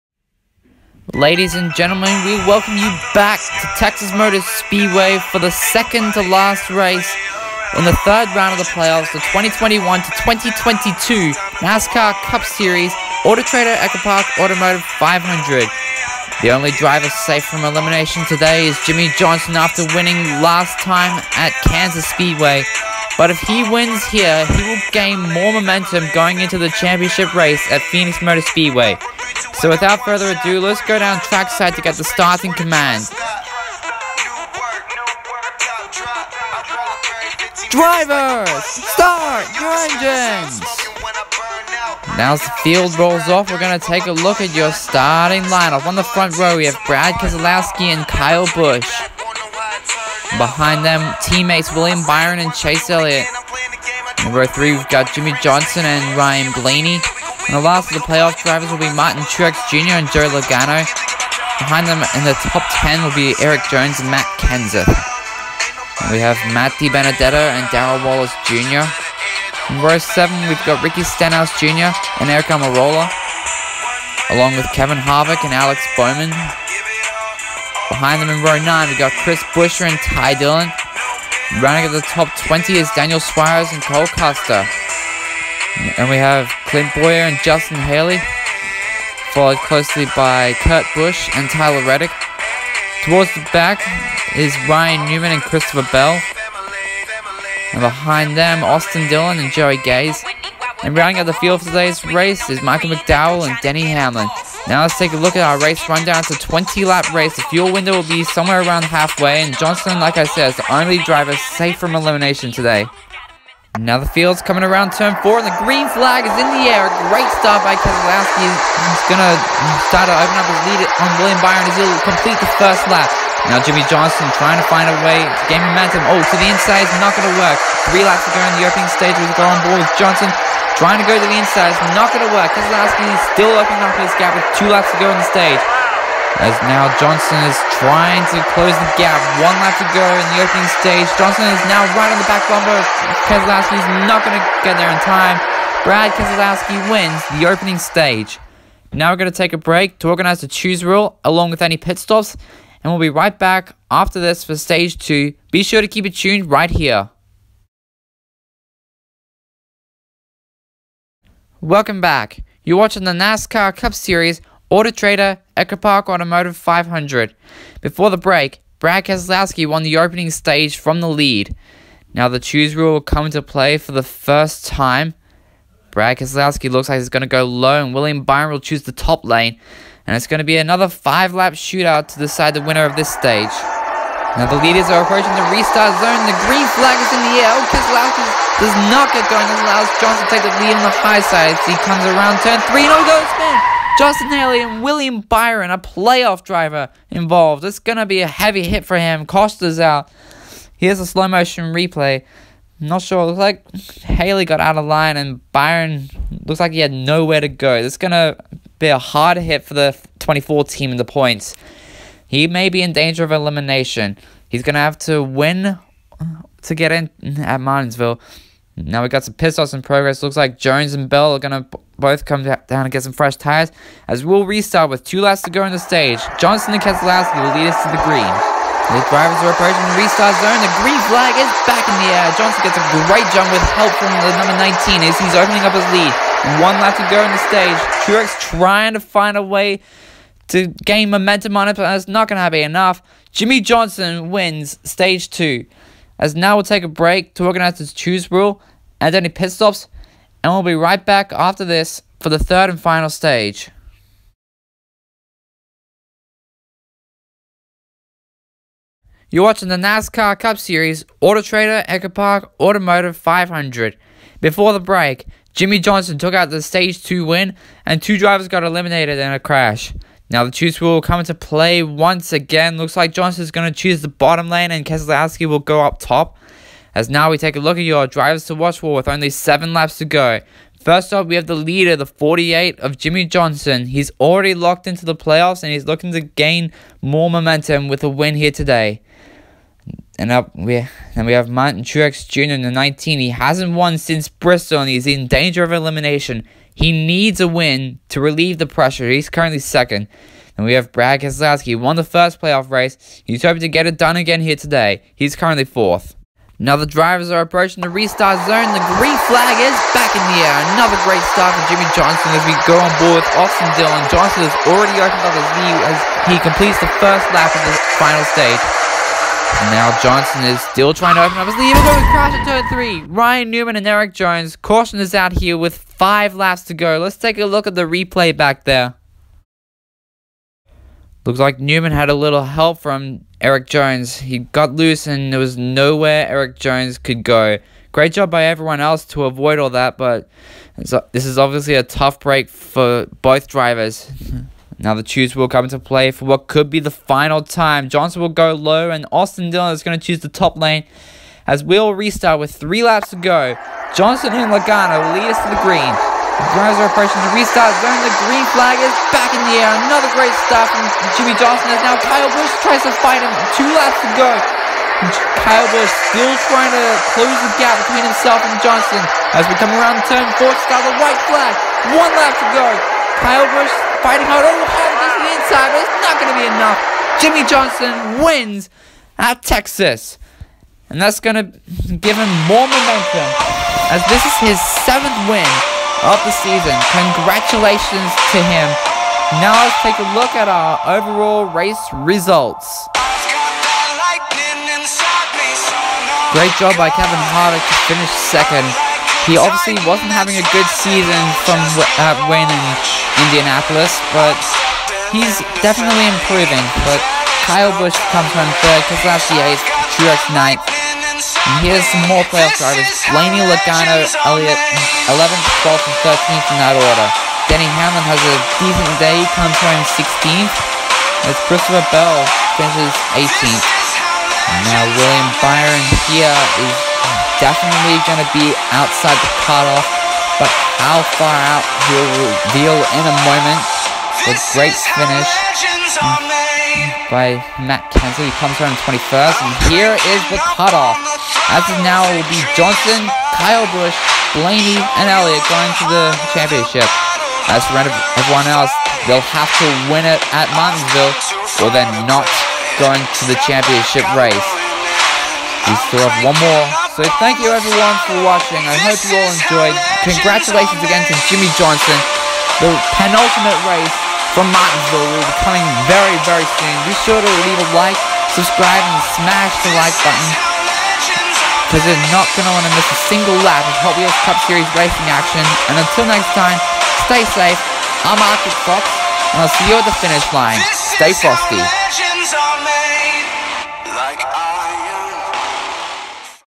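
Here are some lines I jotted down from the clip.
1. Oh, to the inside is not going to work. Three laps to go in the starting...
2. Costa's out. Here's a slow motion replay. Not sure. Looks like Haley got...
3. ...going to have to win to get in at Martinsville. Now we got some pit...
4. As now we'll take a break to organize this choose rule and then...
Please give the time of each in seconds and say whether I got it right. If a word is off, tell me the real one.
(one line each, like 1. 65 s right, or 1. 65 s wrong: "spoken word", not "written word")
1. 126 s wrong: "opening", not "starting"
2. 199 s right
3. 214 s right
4. 246 s right.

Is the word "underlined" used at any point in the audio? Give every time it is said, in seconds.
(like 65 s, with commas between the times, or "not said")
not said.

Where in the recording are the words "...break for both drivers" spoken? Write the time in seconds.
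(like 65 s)
342 s.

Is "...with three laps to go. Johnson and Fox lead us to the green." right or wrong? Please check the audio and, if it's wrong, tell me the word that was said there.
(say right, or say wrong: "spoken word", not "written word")
wrong: "Logano", not "Fox".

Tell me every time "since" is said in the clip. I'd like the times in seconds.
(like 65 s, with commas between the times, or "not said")
293 s.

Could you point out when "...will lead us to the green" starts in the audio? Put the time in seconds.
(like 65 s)
227 s.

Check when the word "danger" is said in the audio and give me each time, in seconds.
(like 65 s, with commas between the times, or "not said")
212 s, 295 s.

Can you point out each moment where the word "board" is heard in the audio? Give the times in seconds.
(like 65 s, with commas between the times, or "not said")
129 s, 313 s.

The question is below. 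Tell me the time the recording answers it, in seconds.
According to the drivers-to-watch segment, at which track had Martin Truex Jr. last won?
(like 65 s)
294 s.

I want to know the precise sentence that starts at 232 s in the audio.
Johnson gets a great jump with help from the number 19 as he's opening up his lead.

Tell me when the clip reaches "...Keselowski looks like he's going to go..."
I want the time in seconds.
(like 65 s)
176 s.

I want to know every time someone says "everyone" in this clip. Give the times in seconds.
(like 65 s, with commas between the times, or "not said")
338 s, 447 s, 457 s.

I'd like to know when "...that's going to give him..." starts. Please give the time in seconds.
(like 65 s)
380 s.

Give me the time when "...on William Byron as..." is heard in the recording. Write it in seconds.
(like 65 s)
120 s.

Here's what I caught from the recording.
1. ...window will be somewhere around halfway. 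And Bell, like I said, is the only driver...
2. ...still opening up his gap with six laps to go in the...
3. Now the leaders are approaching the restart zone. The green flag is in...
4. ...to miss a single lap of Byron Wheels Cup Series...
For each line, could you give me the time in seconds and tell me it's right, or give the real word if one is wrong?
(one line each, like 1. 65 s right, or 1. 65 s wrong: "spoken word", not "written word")
1. 107 s wrong: "Johnson", not "Bell"
2. 133 s wrong: "two", not "six"
3. 184 s right
4. 472 s wrong: "Hot", not "Byron".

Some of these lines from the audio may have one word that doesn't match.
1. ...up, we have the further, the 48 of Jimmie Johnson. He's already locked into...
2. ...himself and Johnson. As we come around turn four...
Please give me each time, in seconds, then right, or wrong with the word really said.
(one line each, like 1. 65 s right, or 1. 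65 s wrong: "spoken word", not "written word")
1. 281 s wrong: "leader", not "further"
2. 368 s right.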